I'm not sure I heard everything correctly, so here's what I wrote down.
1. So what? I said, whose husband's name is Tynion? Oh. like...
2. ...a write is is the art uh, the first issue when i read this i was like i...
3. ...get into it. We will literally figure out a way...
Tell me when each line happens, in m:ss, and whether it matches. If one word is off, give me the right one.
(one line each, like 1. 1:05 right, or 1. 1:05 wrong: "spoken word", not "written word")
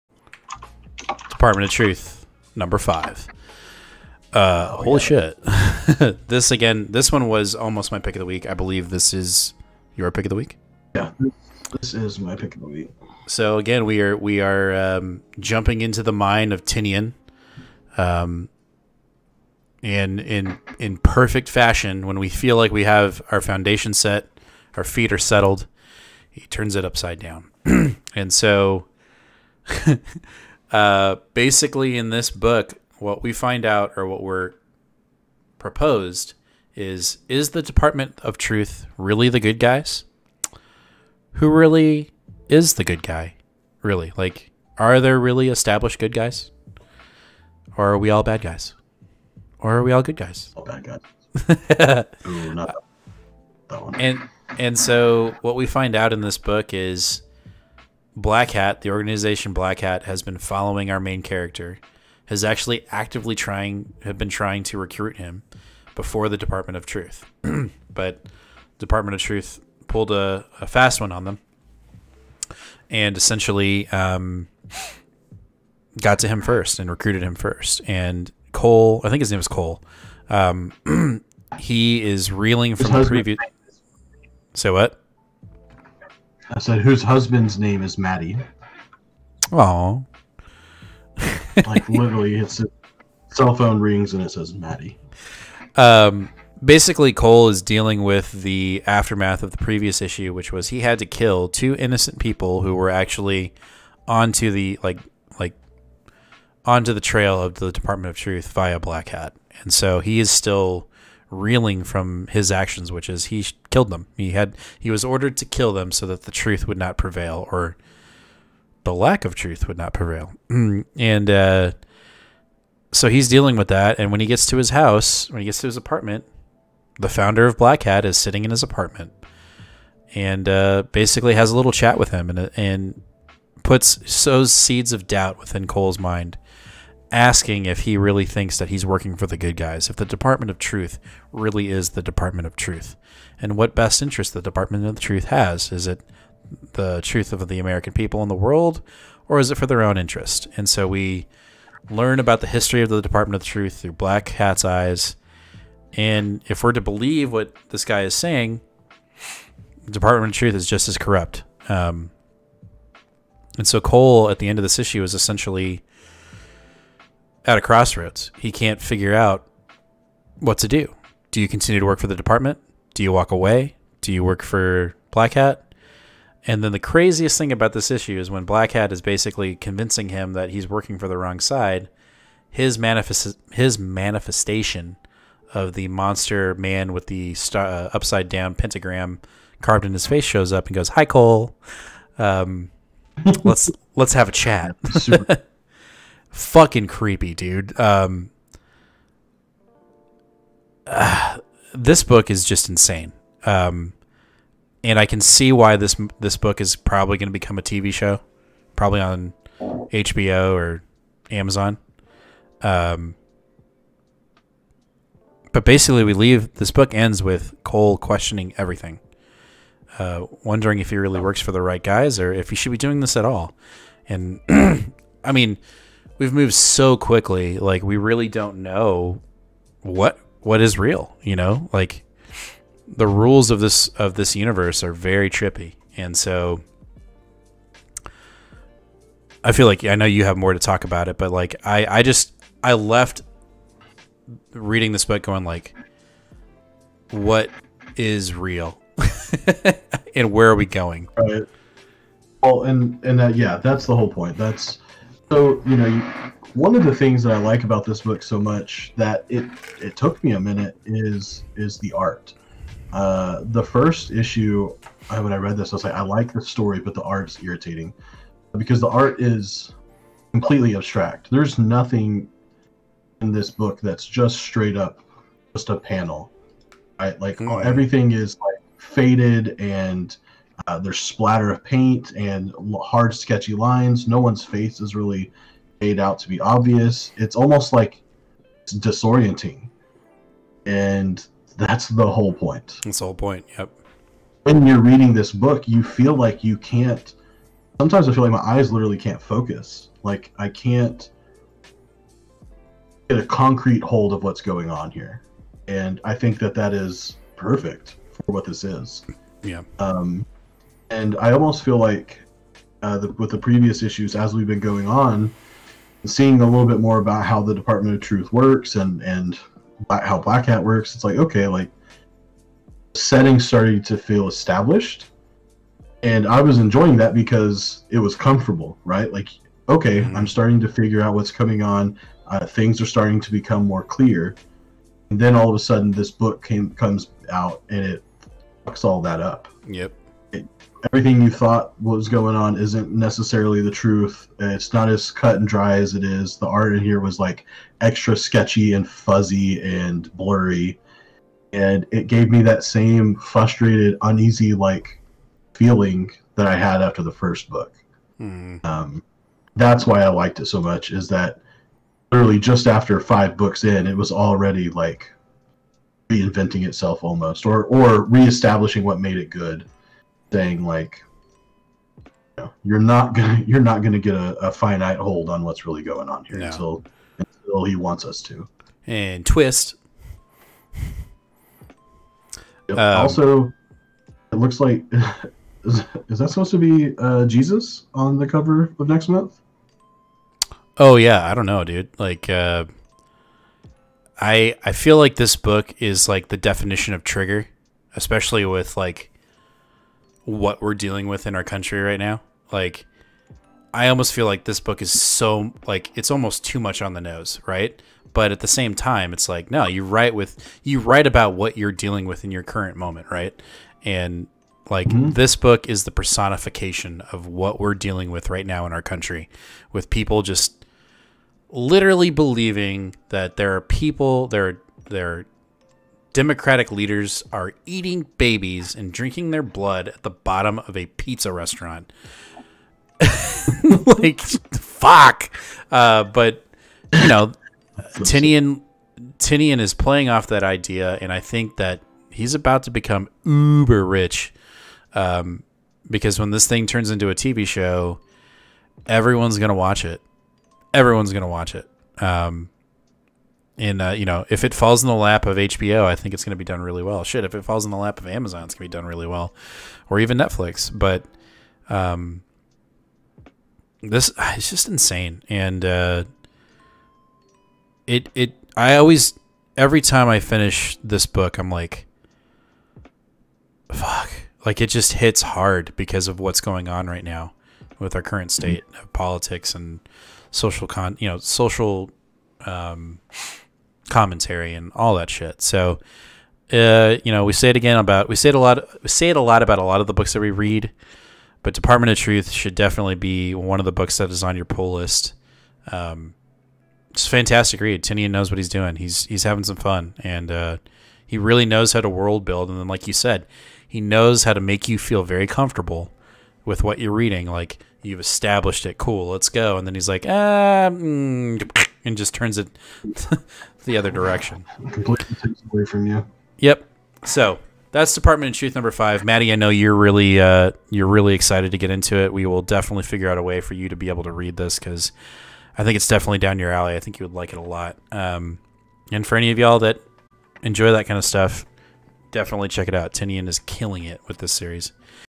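1. 1:24 wrong: "Maddie", not "Tynion"
2. 4:20 wrong: "minute", not "write"
3. 8:41 wrong: "definitely", not "literally".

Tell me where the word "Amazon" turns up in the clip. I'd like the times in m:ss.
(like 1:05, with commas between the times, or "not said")
3:31, 7:38.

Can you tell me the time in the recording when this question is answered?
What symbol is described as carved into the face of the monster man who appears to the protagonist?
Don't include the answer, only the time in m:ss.
3:07.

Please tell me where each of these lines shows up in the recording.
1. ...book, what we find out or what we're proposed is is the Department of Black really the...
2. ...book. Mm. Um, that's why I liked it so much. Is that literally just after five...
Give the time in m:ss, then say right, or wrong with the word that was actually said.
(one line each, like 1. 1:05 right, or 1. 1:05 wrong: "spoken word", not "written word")
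1. 0:32 wrong: "Truth", not "Black"
2. 5:57 right.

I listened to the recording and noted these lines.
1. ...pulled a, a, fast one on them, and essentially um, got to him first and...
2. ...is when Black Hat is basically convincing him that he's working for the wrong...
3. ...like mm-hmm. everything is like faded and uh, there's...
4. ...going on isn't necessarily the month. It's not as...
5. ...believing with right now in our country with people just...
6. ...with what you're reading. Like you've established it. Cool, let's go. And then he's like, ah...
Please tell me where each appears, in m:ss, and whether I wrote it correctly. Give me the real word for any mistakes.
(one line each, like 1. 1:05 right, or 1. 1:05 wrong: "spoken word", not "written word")
1. 1:09 right
2. 2:58 right
3. 4:37 right
4. 5:42 wrong: "truth", not "month"
5. 6:57 wrong: "dealing", not "believing"
6. 8:26 right.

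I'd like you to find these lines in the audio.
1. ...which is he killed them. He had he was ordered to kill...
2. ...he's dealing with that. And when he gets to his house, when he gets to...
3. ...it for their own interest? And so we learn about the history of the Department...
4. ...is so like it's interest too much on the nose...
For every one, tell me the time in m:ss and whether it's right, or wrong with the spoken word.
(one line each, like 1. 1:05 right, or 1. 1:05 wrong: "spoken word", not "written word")
1. 1:52 right
2. 2:03 right
3. 2:29 right
4. 6:44 wrong: "almost", not "interest".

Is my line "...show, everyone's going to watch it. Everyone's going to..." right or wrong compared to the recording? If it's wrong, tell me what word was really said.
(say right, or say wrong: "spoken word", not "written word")
right.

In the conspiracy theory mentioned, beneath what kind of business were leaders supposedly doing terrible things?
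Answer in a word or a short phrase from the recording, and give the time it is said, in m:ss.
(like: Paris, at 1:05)
pizza restaurant, at 7:10.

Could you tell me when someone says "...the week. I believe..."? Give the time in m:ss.
0:08.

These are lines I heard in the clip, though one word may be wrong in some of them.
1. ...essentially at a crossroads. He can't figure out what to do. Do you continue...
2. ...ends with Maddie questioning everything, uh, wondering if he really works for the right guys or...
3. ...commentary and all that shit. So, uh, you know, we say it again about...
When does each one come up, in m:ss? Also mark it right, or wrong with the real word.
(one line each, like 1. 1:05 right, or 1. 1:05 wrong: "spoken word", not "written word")
1. 2:45 right
2. 3:36 wrong: "Cole", not "Maddie"
3. 8:03 right.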